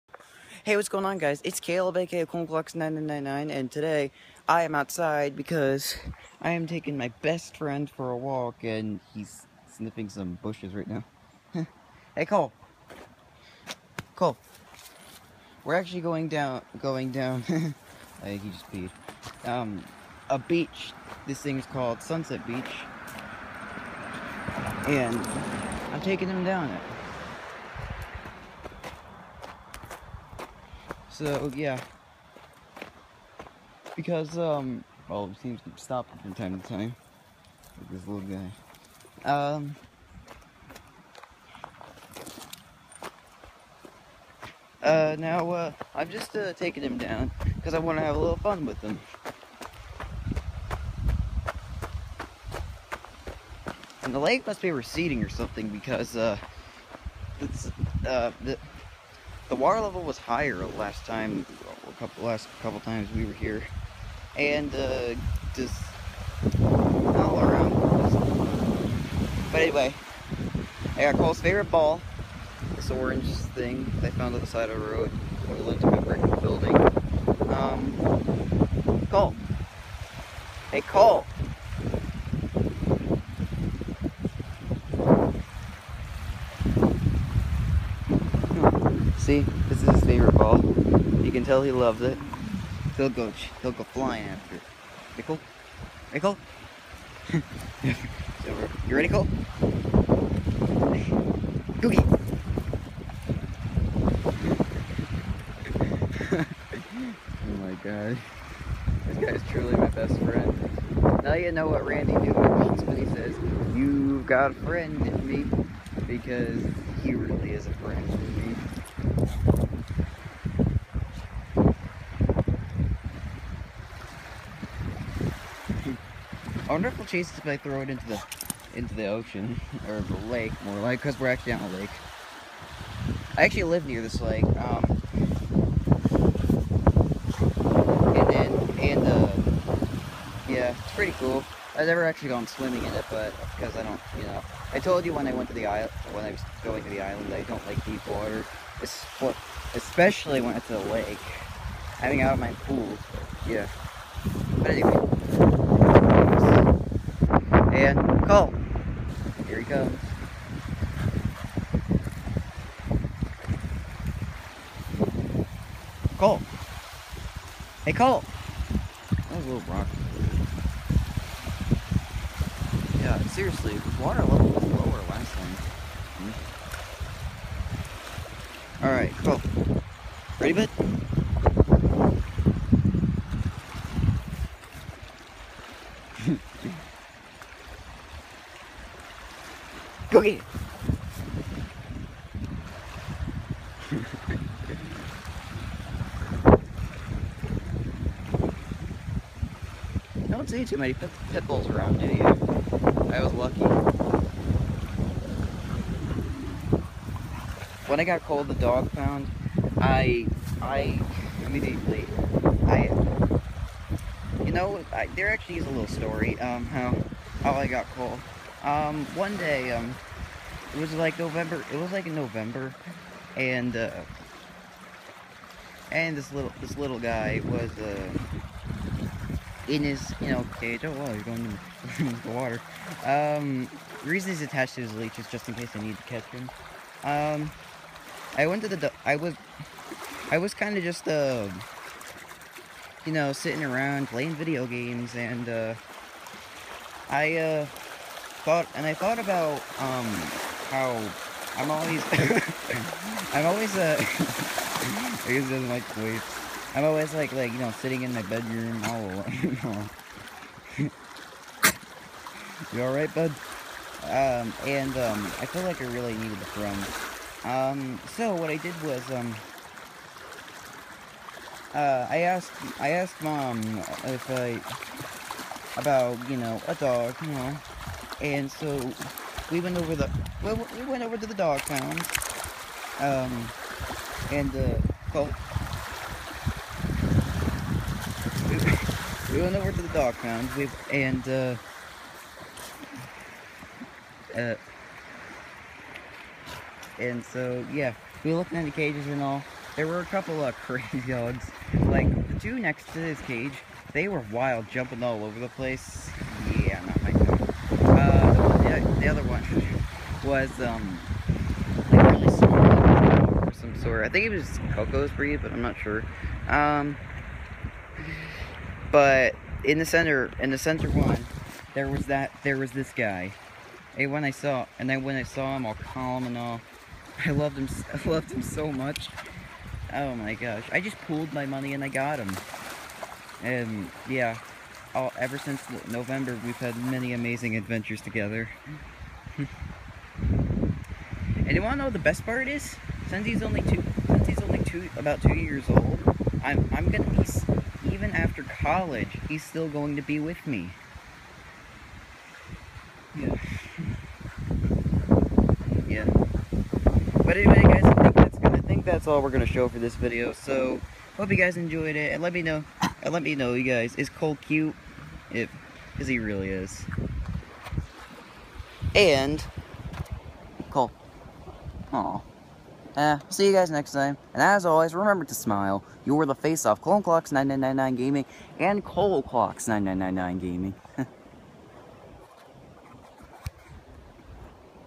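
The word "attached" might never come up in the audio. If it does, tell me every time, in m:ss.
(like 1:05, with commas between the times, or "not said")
3:54.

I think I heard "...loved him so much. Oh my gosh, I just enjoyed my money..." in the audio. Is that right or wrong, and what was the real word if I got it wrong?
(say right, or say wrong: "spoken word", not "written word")
wrong: "pulled", not "enjoyed".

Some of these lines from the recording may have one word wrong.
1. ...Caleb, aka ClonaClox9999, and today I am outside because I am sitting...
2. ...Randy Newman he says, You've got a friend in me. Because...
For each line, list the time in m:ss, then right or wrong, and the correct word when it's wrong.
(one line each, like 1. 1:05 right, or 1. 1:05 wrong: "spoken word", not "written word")
1. 0:01 wrong: "taking", not "sitting"
2. 1:51 right.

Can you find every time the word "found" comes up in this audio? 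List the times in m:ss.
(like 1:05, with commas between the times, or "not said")
1:14, 3:28.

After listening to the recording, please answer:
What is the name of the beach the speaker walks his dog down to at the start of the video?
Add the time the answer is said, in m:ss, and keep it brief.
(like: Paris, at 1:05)
Sunset Beach, at 0:22.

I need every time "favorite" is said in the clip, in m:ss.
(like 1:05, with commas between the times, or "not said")
1:11, 1:30.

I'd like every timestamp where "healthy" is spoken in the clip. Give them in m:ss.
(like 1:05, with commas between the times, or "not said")
not said.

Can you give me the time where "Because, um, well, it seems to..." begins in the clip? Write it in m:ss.
0:33.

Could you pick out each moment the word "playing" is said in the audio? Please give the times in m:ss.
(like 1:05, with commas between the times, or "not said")
4:04.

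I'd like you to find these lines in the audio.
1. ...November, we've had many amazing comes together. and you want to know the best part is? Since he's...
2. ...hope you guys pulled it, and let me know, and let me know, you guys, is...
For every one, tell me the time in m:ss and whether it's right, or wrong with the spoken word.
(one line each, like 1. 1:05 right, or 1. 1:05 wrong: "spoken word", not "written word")
1. 5:35 wrong: "adventures", not "comes"
2. 6:01 wrong: "enjoyed", not "pulled".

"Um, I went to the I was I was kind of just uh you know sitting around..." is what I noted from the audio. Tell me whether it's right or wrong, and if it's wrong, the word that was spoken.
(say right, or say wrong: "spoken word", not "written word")
right.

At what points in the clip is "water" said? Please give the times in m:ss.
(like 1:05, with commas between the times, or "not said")
0:59, 2:28, 2:54, 3:52.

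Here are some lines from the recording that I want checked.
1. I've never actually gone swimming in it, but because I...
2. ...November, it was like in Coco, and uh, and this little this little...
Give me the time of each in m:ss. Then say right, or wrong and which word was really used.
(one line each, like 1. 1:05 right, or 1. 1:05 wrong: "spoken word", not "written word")
1. 2:21 right
2. 3:41 wrong: "November", not "Coco".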